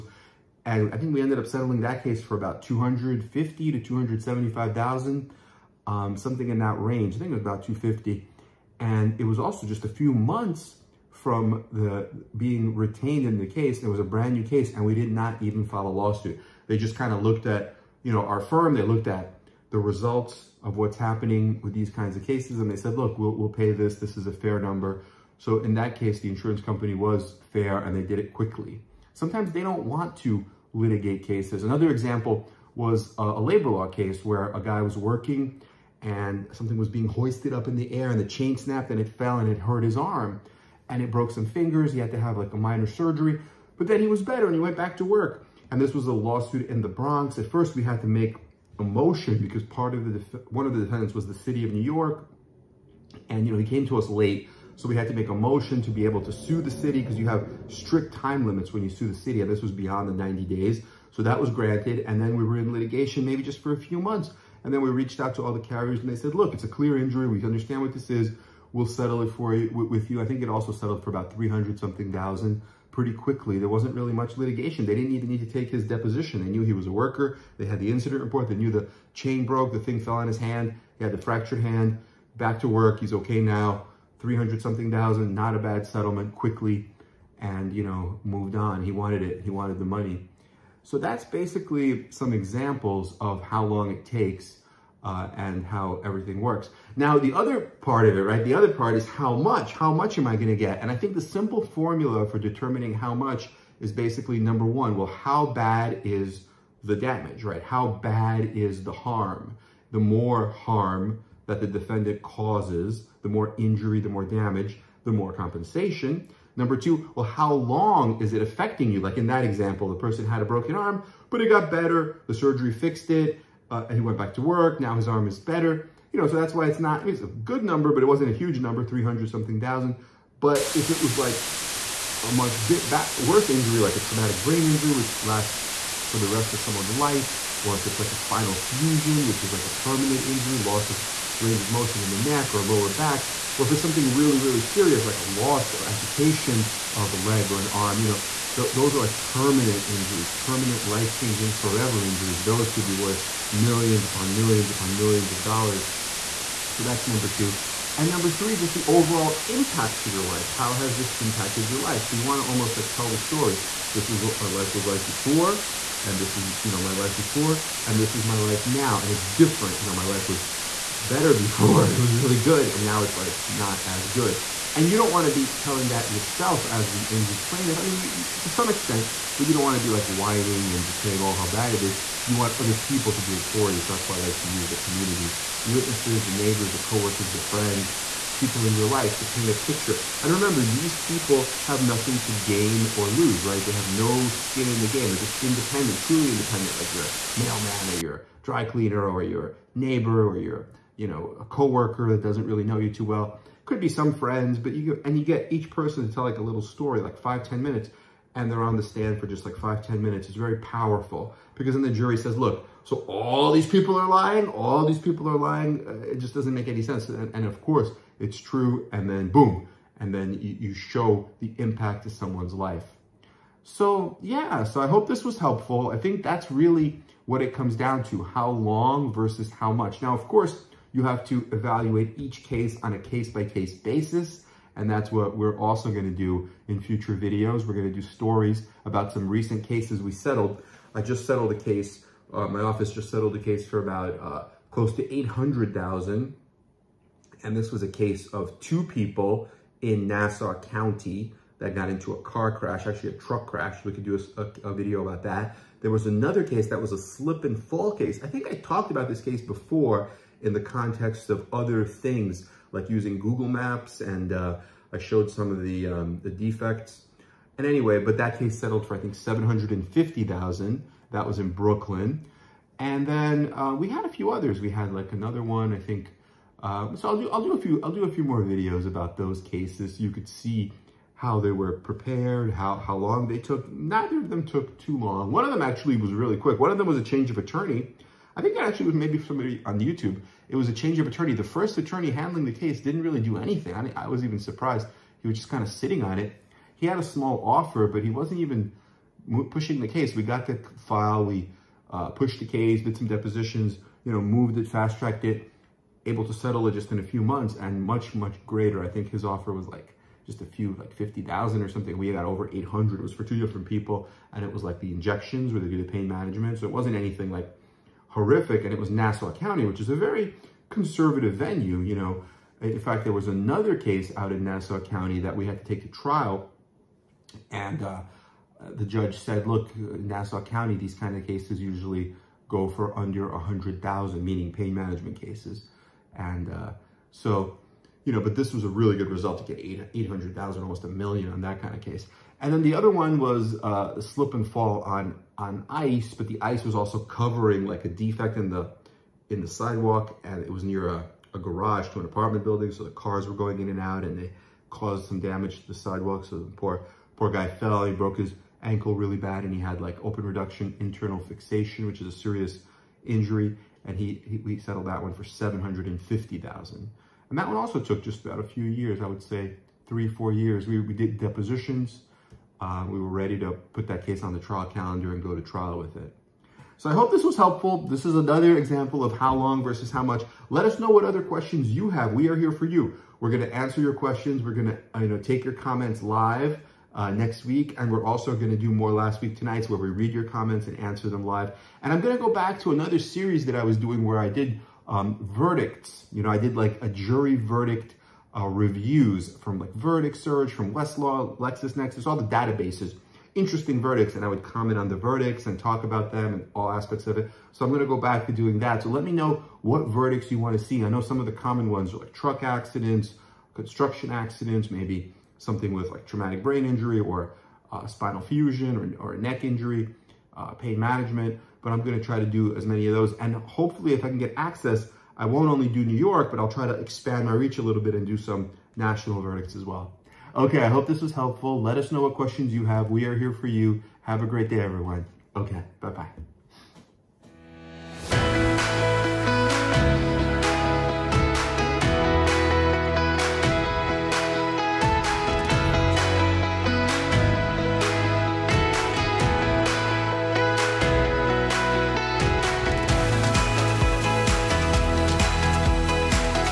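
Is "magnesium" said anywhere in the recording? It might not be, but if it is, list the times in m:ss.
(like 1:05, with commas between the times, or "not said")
not said.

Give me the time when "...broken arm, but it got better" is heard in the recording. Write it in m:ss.
2:00.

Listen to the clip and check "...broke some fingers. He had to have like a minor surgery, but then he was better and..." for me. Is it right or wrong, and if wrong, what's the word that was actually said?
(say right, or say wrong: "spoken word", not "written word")
right.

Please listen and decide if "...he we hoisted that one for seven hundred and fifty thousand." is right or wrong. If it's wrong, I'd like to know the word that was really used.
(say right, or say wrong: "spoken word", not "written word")
wrong: "settled", not "hoisted".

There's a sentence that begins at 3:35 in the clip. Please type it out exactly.
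Uh, it just doesn't make any sense.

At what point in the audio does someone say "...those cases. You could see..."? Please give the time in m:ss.
4:39.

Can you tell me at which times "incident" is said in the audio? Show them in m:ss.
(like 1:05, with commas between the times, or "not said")
1:17.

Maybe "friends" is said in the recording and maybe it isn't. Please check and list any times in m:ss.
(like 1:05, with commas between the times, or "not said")
3:07, 3:24.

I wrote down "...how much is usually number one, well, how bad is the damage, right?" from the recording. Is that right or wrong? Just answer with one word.
wrong.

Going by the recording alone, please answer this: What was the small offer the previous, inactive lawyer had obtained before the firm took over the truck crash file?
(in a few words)
50,000.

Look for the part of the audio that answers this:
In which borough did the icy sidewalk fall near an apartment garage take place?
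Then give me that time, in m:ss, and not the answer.
4:31.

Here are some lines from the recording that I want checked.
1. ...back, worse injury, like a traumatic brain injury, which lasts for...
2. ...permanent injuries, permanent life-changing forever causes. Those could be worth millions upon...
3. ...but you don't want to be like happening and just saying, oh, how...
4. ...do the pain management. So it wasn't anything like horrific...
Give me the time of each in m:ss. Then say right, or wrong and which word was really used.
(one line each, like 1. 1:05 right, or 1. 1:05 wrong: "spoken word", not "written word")
1. 2:12 right
2. 2:29 wrong: "injuries", not "causes"
3. 2:59 wrong: "whining", not "happening"
4. 5:15 right.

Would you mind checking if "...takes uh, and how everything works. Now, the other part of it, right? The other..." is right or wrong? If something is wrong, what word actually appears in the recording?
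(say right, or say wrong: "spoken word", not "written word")
right.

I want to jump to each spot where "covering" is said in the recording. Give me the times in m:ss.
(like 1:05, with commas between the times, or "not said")
5:46.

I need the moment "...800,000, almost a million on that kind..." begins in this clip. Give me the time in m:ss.
5:39.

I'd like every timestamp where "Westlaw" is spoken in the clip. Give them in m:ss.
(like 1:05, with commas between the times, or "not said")
6:40.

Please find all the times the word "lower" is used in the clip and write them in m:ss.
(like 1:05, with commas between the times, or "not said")
2:22.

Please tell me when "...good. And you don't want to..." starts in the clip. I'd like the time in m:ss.
2:54.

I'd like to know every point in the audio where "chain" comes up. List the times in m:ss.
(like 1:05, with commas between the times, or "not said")
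0:38, 1:19.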